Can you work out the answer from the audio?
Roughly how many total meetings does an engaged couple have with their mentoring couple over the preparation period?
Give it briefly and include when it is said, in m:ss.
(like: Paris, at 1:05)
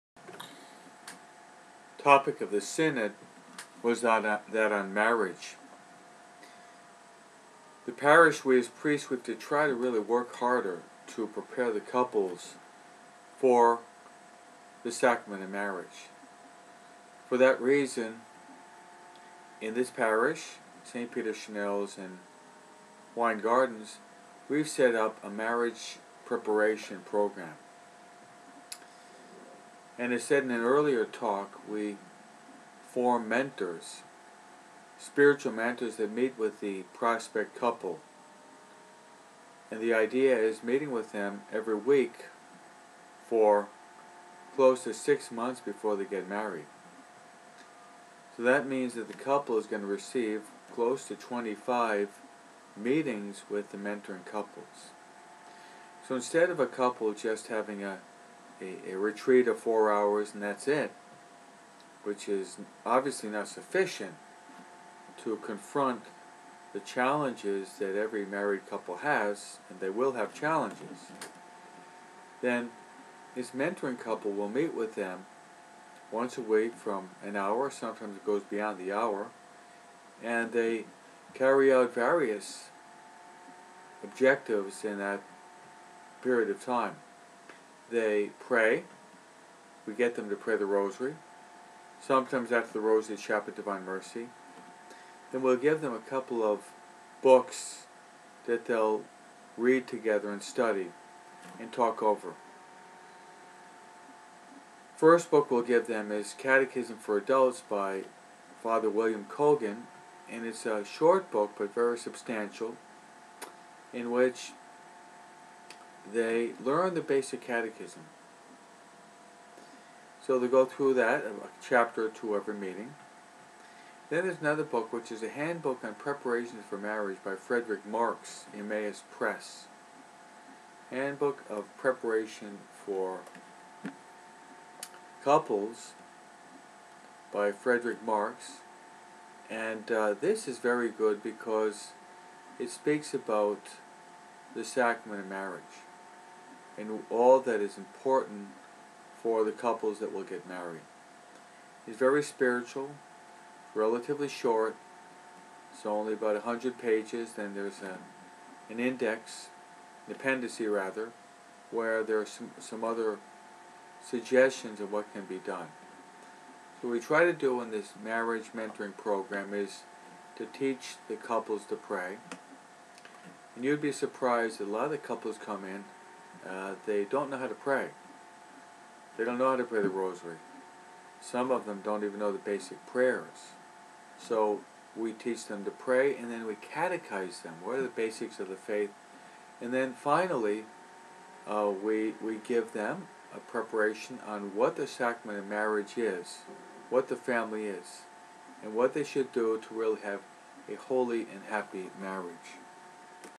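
25, at 0:51.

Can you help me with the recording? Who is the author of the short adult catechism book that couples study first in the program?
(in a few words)
Father William Cogan.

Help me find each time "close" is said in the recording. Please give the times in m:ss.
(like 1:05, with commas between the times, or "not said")
0:44, 0:50.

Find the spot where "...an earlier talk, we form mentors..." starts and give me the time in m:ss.
0:30.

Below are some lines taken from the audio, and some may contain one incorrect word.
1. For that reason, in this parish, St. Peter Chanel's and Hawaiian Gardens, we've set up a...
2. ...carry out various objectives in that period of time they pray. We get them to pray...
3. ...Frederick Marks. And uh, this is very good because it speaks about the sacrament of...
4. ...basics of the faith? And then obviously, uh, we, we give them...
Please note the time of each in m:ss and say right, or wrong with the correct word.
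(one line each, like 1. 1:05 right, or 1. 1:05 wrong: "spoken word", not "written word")
1. 0:17 right
2. 1:21 right
3. 2:17 right
4. 3:07 wrong: "finally", not "obviously".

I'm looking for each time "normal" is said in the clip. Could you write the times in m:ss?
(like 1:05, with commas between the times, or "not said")
not said.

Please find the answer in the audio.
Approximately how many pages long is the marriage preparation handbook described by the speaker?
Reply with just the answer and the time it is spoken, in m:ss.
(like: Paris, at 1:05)
100, at 2:36.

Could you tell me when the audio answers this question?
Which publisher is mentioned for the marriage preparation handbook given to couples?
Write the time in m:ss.
2:08.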